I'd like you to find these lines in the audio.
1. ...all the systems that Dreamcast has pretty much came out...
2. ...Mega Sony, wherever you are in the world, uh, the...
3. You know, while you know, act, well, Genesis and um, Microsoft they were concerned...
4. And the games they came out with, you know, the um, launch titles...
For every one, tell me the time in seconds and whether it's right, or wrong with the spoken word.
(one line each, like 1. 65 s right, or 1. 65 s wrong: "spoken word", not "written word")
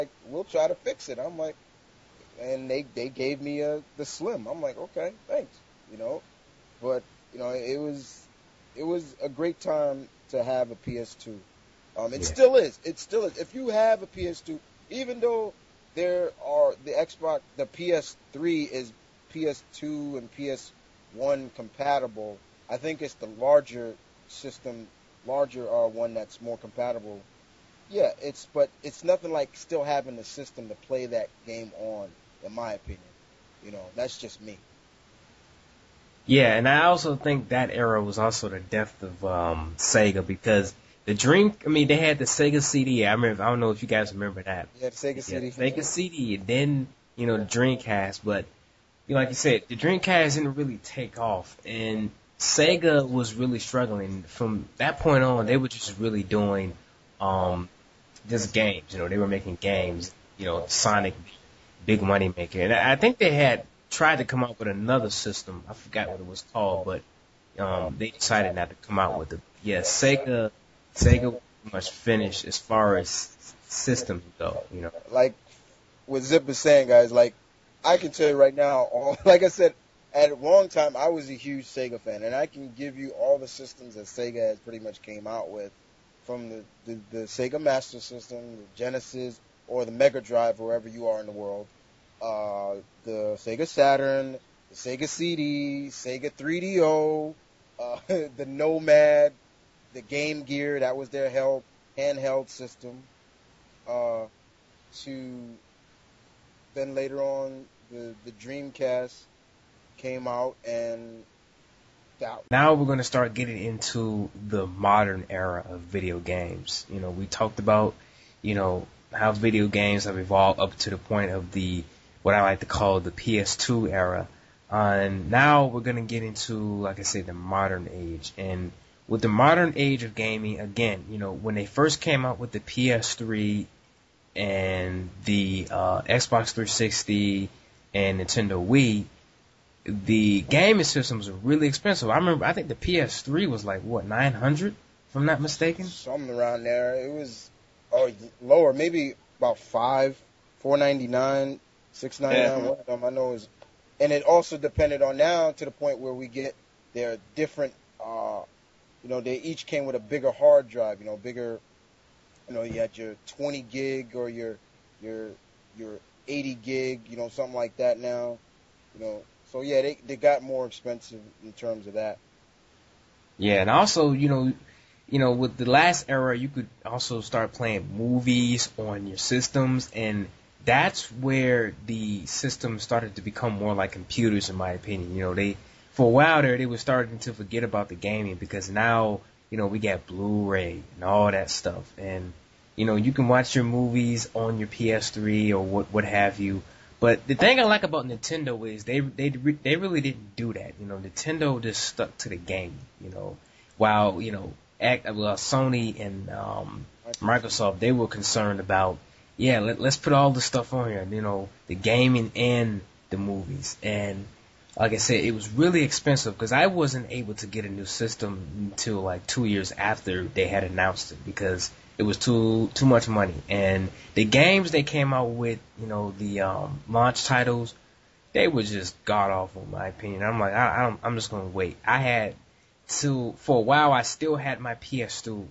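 1. 83 s wrong: "Sega", not "Dreamcast"
2. 89 s wrong: "Drive", not "Sony"
3. 203 s wrong: "Sony", not "Genesis"
4. 223 s right.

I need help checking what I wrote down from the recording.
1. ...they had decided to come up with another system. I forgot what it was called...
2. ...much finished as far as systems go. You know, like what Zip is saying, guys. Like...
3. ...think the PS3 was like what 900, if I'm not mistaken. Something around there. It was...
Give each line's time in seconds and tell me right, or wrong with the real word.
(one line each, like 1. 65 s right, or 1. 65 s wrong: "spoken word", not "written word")
1. 63 s wrong: "tried", not "decided"
2. 71 s right
3. 142 s right.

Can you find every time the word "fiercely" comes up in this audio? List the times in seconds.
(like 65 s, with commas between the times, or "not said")
not said.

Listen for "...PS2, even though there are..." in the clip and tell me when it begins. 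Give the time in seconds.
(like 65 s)
14 s.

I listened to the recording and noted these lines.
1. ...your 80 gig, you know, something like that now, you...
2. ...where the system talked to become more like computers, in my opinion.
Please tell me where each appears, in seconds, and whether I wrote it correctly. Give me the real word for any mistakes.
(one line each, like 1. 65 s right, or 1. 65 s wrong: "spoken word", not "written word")
1. 165 s right
2. 181 s wrong: "started", not "talked".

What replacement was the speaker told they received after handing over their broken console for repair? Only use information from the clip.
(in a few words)
the slim.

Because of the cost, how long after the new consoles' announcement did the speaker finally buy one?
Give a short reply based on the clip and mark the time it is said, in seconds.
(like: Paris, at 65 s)
2 years, at 219 s.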